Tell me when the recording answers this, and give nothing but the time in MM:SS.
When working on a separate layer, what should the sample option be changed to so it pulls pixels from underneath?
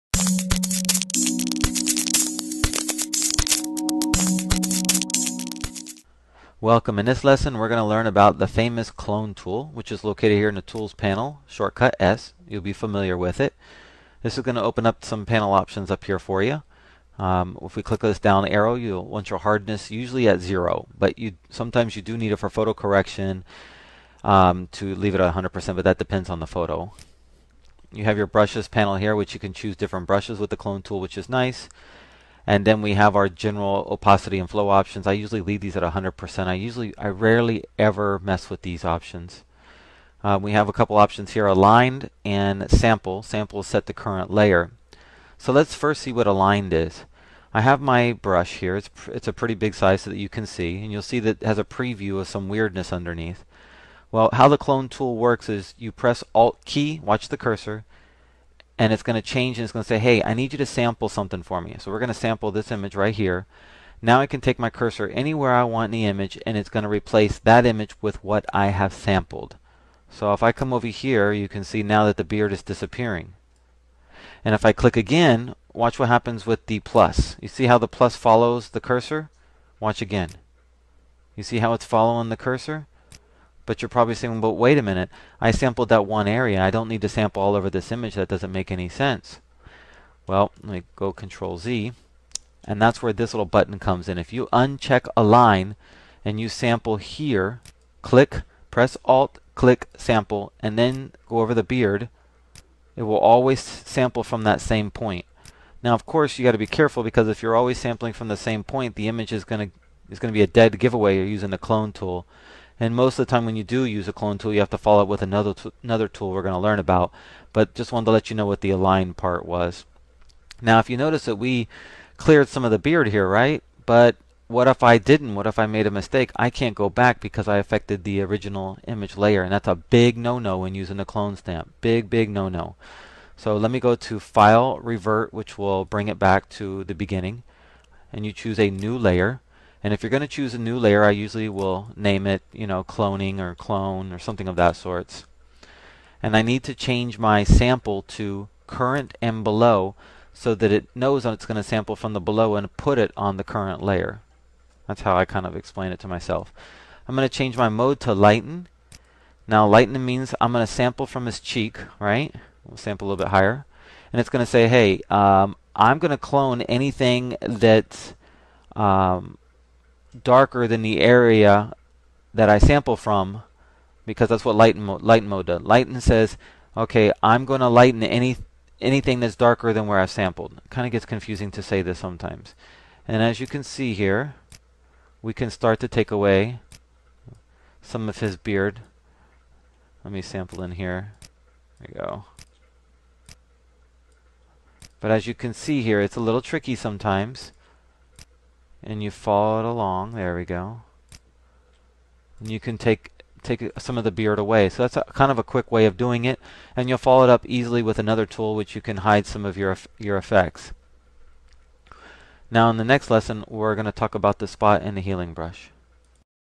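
02:28.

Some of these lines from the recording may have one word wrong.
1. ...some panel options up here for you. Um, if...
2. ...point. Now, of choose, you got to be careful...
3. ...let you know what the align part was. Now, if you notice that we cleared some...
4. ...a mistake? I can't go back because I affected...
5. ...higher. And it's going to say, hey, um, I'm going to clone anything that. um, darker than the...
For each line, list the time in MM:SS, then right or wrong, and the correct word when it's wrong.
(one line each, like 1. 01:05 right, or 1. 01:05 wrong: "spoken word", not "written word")
1. 00:15 right
2. 01:44 wrong: "course", not "choose"
3. 01:58 right
4. 02:05 right
5. 02:43 right.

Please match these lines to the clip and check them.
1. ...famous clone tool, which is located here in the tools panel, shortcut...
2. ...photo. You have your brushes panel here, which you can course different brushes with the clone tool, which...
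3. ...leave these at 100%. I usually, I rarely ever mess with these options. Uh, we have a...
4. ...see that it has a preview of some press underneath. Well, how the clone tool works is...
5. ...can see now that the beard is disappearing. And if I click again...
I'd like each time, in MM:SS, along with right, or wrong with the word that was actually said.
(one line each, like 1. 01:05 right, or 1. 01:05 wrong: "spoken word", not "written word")
1. 00:08 right
2. 00:26 wrong: "choose", not "course"
3. 00:35 right
4. 00:51 wrong: "weirdness", not "press"
5. 01:11 right.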